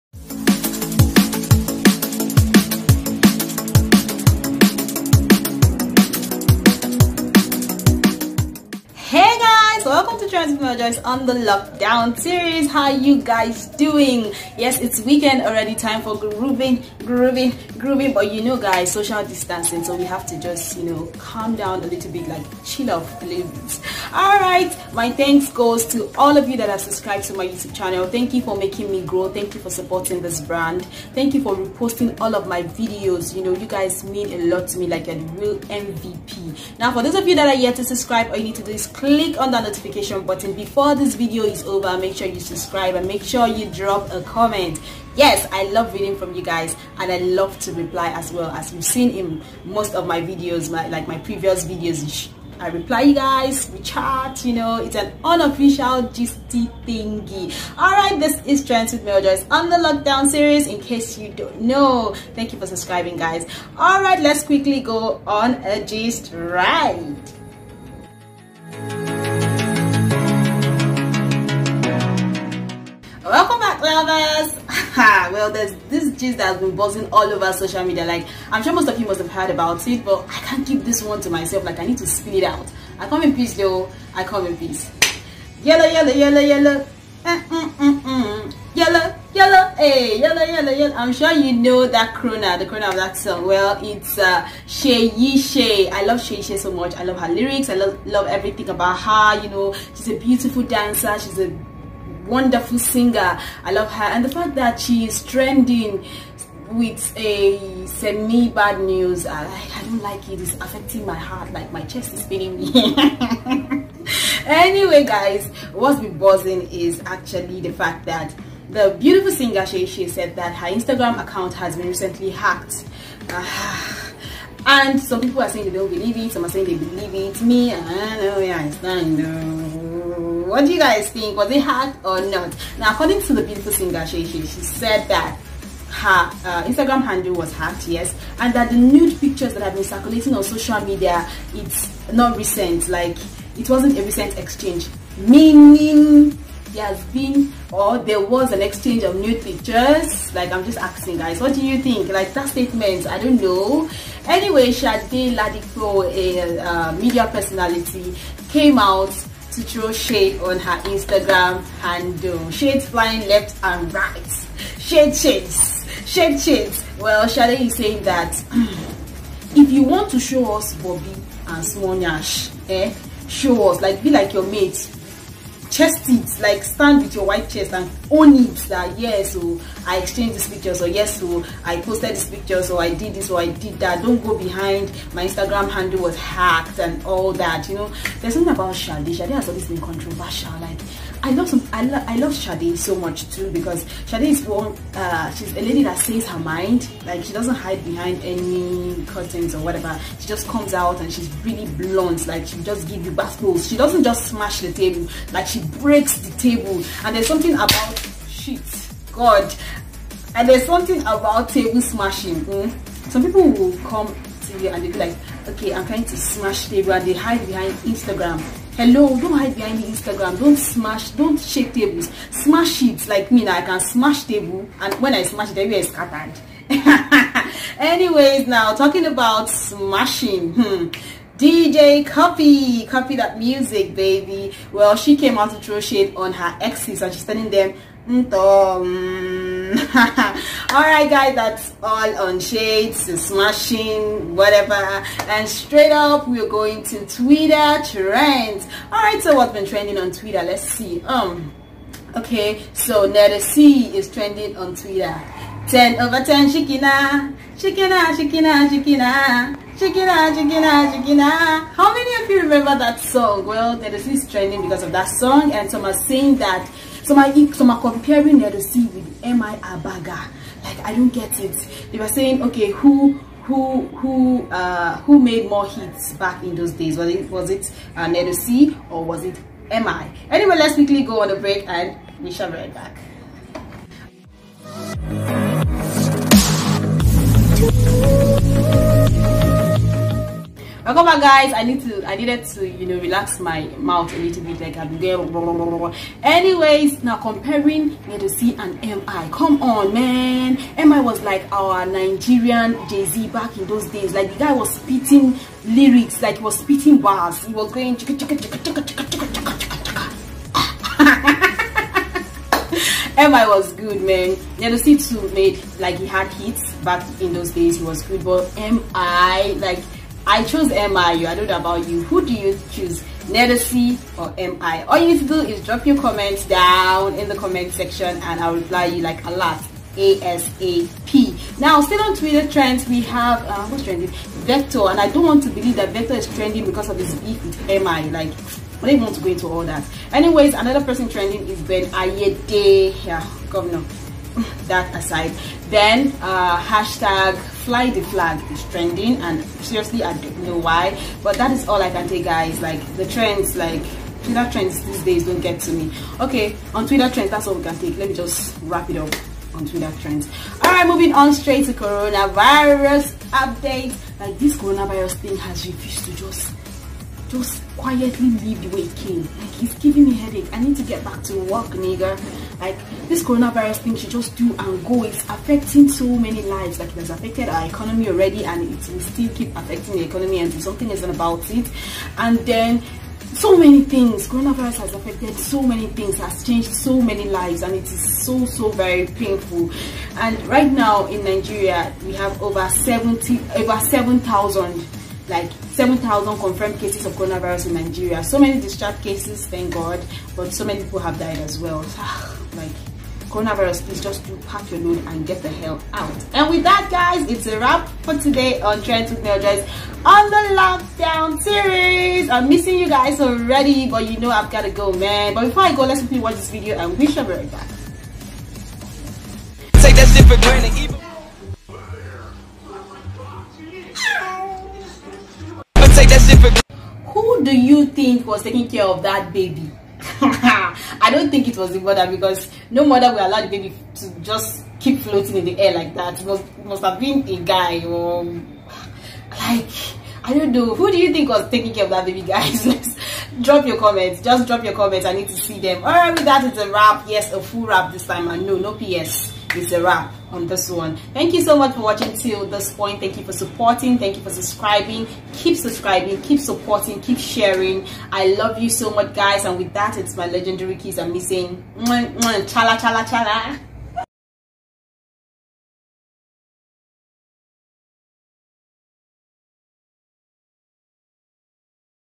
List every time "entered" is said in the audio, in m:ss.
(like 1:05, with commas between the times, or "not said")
not said.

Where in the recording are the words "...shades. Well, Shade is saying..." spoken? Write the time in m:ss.
2:46.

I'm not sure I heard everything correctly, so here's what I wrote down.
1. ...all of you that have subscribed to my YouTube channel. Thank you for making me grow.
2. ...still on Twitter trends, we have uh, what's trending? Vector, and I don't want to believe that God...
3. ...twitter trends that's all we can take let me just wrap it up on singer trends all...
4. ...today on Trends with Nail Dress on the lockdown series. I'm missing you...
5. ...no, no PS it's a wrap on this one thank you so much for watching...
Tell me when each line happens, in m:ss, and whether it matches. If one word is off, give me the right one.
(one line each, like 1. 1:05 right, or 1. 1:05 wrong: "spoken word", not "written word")
1. 0:26 right
2. 5:31 wrong: "Vector", not "God"
3. 5:56 wrong: "twitter", not "singer"
4. 6:48 right
5. 7:28 right.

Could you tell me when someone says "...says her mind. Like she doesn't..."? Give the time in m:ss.
3:15.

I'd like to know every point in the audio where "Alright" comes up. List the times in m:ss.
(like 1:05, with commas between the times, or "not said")
0:57, 1:03.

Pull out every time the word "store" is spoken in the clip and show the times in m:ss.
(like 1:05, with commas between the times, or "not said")
not said.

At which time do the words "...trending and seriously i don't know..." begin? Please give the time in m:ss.
5:48.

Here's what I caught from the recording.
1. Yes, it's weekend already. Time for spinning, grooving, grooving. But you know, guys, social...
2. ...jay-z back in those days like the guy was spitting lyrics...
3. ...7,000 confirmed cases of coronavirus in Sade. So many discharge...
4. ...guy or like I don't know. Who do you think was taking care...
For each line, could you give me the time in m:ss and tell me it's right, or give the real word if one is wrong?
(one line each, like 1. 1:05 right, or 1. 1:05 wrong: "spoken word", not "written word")
1. 0:14 wrong: "grooving", not "spinning"
2. 5:02 right
3. 6:35 wrong: "Nigeria", not "Sade"
4. 7:17 right.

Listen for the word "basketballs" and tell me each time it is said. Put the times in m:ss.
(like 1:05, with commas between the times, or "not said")
3:23.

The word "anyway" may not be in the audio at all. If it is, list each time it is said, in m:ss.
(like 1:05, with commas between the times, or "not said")
1:54, 2:34, 3:47, 4:40, 4:56, 5:40.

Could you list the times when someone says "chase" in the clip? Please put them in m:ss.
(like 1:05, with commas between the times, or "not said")
not said.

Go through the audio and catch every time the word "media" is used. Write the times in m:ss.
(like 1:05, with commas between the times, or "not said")
1:17, 2:20, 2:36.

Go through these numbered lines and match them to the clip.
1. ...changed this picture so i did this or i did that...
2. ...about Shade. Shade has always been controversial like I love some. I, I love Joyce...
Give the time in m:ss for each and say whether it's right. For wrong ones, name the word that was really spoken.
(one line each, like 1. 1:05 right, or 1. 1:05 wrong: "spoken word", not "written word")
1. 3:01 wrong: "posted", not "changed"
2. 3:08 wrong: "Sade", not "Joyce".